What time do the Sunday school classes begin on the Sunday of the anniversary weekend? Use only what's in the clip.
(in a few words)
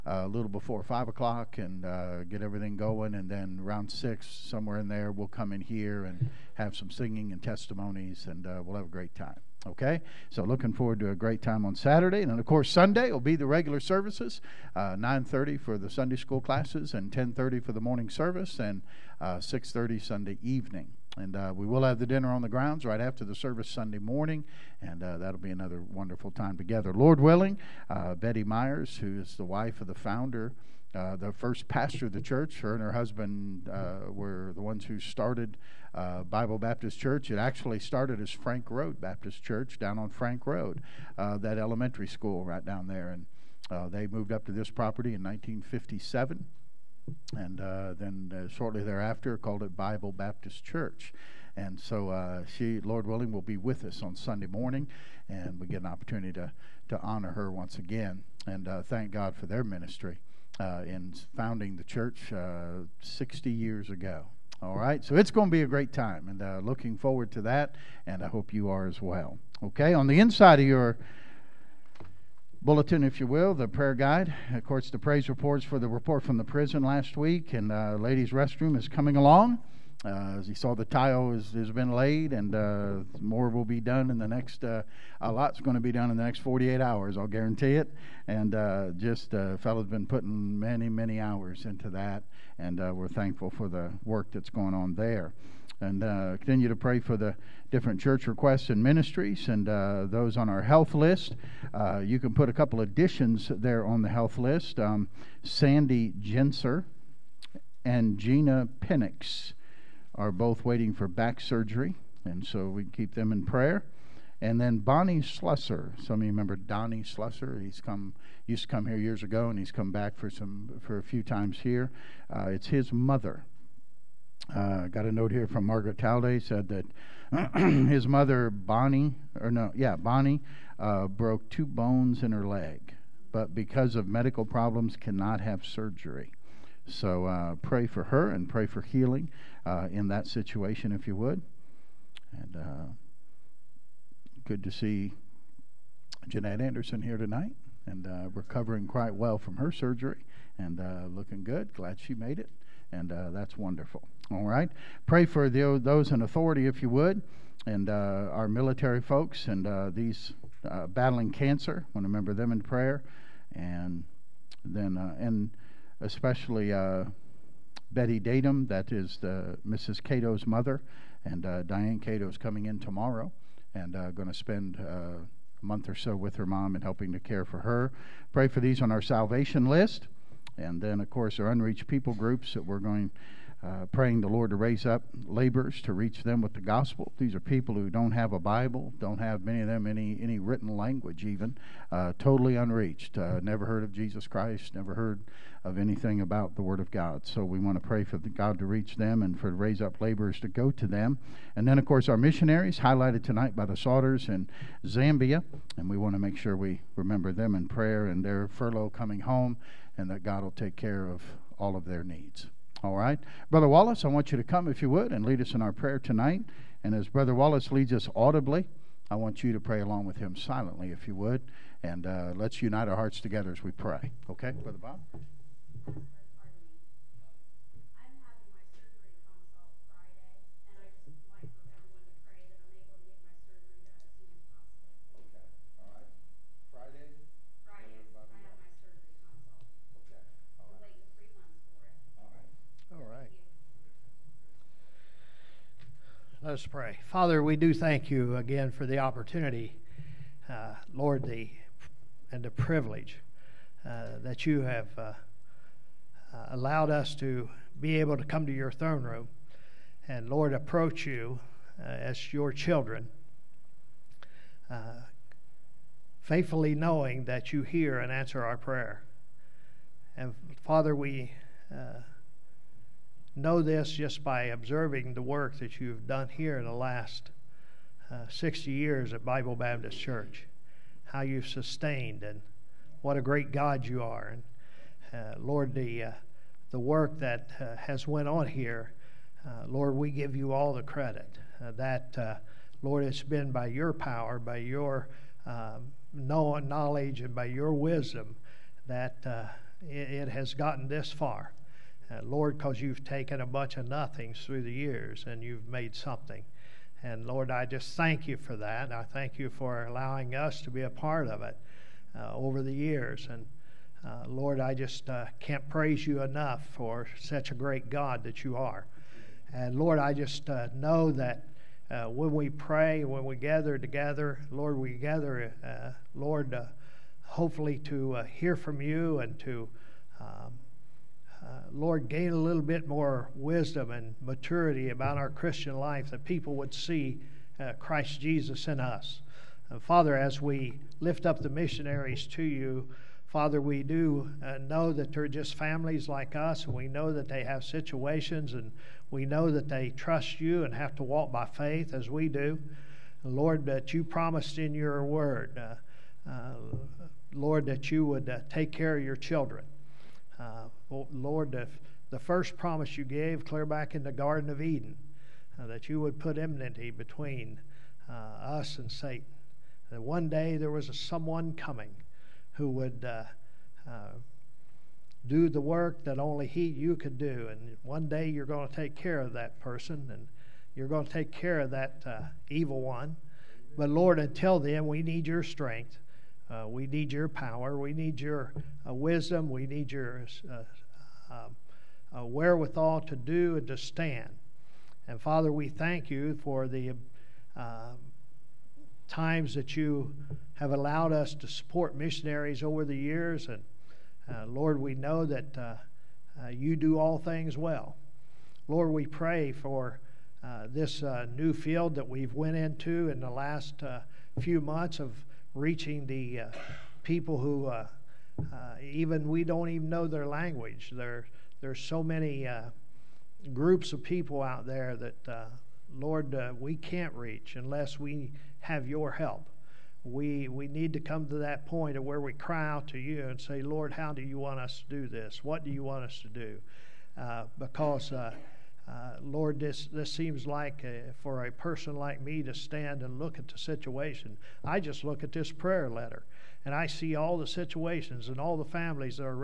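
9:30.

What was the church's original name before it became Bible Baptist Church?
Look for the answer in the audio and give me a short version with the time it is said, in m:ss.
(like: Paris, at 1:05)
Frank Road Baptist Church, at 0:38.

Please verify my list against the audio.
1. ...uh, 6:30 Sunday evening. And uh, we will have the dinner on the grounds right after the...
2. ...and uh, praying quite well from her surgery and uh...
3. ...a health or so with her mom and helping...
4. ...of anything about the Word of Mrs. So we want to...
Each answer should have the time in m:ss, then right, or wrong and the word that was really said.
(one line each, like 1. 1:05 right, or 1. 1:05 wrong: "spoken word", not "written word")
1. 0:19 right
2. 2:27 wrong: "recovering", not "praying"
3. 2:55 wrong: "month", not "health"
4. 3:15 wrong: "God", not "Mrs".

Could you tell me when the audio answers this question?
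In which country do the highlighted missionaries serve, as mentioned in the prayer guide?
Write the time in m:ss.
3:24.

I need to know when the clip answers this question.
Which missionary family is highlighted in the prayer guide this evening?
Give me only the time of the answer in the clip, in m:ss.
3:23.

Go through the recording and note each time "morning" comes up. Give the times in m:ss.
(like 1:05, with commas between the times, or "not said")
0:17, 0:23, 0:54.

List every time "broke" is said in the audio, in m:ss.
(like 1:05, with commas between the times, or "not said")
2:11.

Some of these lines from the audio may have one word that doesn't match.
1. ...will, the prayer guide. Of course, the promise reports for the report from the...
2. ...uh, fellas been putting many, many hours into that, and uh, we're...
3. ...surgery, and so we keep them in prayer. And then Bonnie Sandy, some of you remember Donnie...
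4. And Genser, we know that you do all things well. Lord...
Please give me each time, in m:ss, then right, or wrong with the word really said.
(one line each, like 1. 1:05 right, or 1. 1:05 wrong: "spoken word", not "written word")
1. 1:13 wrong: "praise", not "promise"
2. 1:29 right
3. 1:51 wrong: "Slusser", not "Sandy"
4. 6:43 wrong: "Lord", not "Genser".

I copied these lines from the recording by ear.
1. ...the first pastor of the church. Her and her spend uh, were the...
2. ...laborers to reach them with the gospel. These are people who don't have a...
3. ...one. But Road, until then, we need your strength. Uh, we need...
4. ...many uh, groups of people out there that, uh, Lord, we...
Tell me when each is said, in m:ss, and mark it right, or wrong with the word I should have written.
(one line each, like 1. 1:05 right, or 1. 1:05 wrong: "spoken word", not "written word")
1. 0:31 wrong: "husband", not "spend"
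2. 3:05 right
3. 6:22 wrong: "Lord", not "Road"
4. 7:02 right.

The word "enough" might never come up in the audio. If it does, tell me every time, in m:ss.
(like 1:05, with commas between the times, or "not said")
5:16.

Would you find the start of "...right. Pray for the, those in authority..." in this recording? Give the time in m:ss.
2:34.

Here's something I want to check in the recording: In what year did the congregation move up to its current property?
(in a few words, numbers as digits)
1957.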